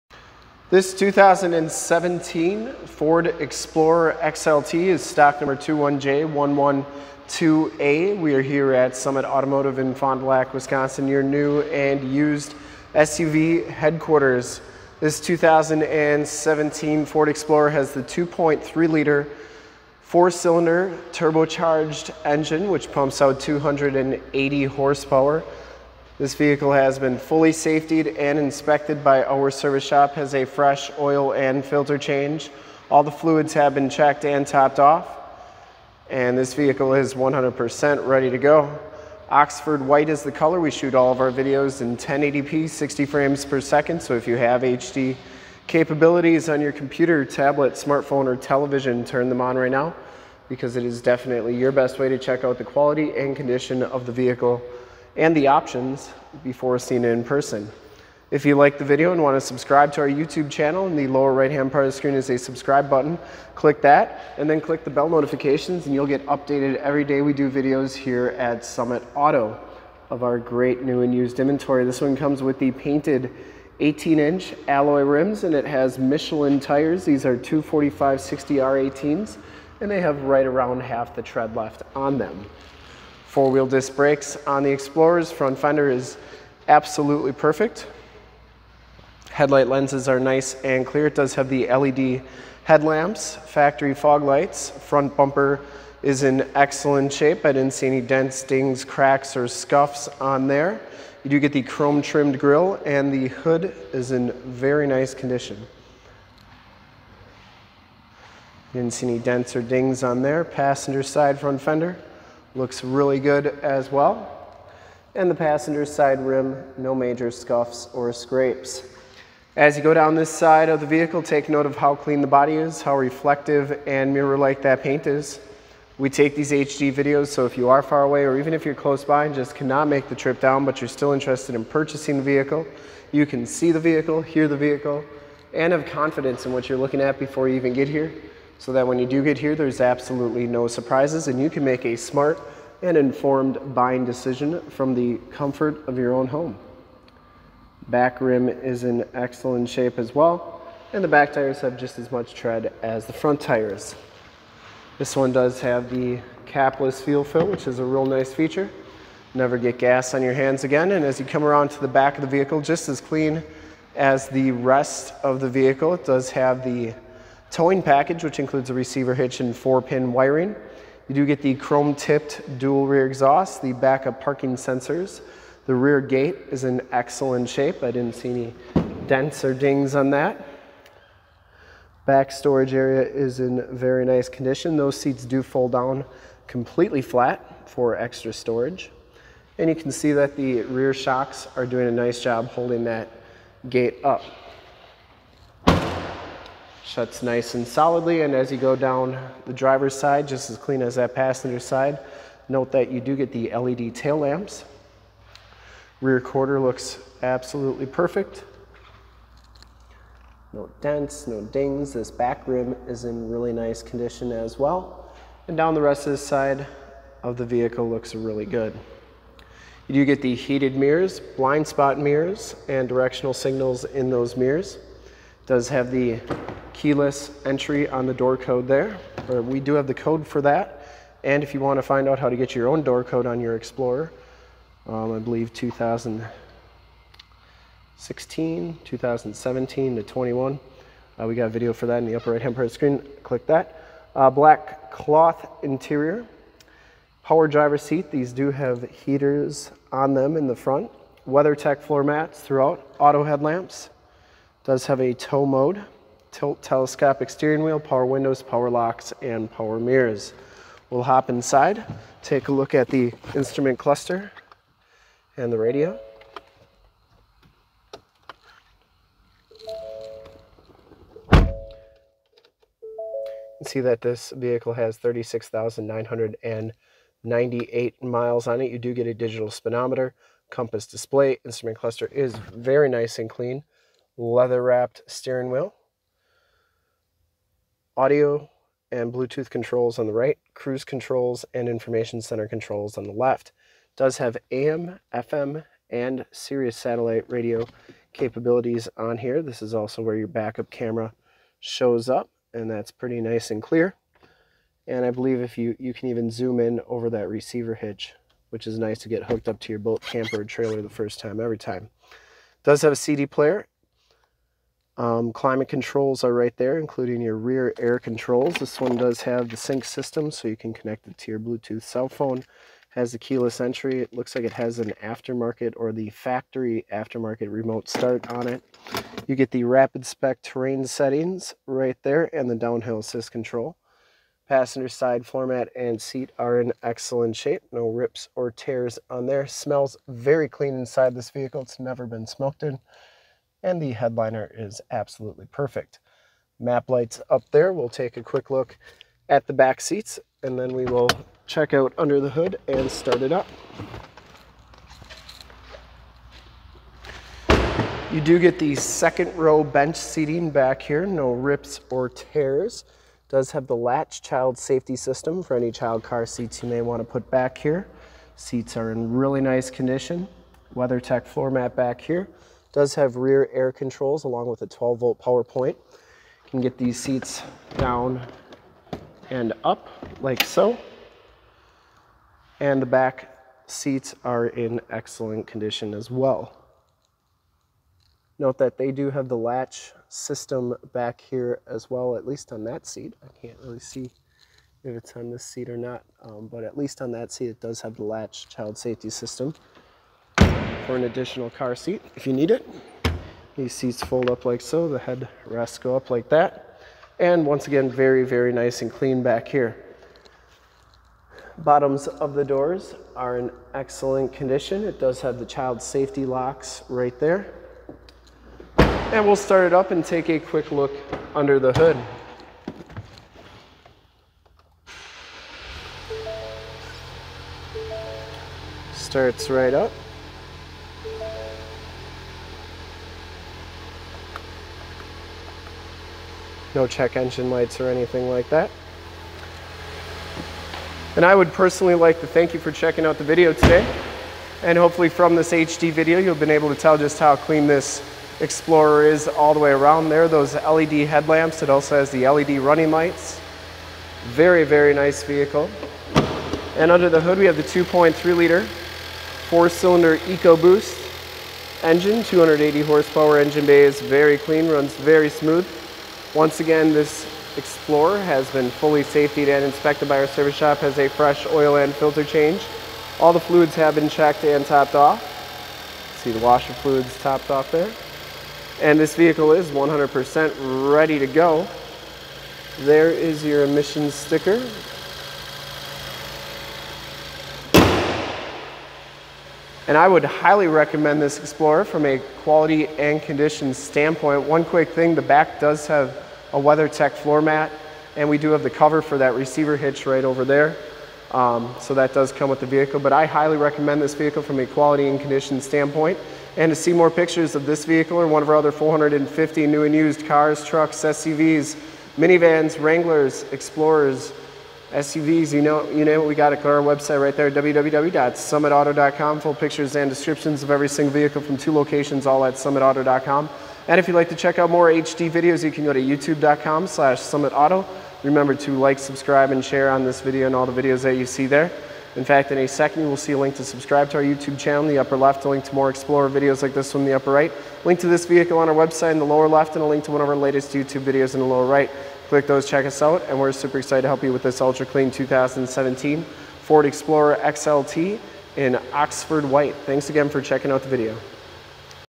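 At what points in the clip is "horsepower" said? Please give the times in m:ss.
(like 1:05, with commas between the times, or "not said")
0:24, 7:42.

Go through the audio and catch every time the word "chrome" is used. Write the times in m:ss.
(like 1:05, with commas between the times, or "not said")
1:41, 2:51.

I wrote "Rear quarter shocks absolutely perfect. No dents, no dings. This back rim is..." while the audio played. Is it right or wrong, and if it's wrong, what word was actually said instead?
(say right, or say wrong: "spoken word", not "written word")
wrong: "looks", not "shocks".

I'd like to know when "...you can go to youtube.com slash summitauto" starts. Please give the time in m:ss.
8:45.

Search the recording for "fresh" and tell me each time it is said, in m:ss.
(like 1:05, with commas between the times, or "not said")
0:30, 7:51.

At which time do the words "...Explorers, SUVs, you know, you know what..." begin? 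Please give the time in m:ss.
8:33.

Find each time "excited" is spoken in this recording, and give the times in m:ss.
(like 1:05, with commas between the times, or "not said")
9:03.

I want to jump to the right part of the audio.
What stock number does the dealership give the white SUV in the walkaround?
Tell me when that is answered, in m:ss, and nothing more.
0:05.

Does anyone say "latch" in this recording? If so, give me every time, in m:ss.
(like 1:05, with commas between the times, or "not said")
6:03, 6:29, 6:38.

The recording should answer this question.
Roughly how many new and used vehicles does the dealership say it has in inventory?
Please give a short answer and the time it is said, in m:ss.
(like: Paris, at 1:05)
450, at 8:28.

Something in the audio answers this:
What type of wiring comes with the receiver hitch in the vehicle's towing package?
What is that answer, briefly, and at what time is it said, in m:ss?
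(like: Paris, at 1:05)
Four pin, at 2:49.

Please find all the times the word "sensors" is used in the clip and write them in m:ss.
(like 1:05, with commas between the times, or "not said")
2:54.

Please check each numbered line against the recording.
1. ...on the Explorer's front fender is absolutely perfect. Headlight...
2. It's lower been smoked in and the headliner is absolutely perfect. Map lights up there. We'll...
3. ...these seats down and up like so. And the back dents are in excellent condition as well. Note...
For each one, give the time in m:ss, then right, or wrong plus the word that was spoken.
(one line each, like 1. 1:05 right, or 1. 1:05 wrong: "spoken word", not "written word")
1. 1:24 right
2. 5:41 wrong: "never", not "lower"
3. 6:16 wrong: "seats", not "dents".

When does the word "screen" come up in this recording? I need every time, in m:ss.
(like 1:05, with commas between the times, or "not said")
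1:01, 4:02.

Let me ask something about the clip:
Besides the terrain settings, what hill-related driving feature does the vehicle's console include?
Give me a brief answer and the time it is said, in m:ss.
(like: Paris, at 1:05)
Downhill assist control, at 5:32.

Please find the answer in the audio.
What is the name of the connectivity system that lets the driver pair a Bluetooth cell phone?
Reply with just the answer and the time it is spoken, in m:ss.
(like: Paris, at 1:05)
Sync, at 5:19.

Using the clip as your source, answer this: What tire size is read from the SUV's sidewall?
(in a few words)
245 60R18.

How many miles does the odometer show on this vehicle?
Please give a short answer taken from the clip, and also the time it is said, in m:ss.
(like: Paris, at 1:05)
36,998, at 4:34.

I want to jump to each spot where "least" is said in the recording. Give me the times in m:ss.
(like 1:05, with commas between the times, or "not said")
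6:32, 6:36.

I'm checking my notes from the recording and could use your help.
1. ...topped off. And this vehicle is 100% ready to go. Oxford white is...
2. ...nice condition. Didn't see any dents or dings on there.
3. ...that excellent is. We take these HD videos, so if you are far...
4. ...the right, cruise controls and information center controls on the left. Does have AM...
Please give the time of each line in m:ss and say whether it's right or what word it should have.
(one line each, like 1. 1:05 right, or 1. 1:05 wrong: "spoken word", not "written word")
1. 0:34 right
2. 1:44 right
3. 2:04 wrong: "paint", not "excellent"
4. 4:50 right.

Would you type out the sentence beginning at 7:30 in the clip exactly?
Those LED headlamps, it also has the LED running lights.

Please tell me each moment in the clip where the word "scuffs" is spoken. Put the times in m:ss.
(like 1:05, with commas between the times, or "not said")
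1:39, 1:57.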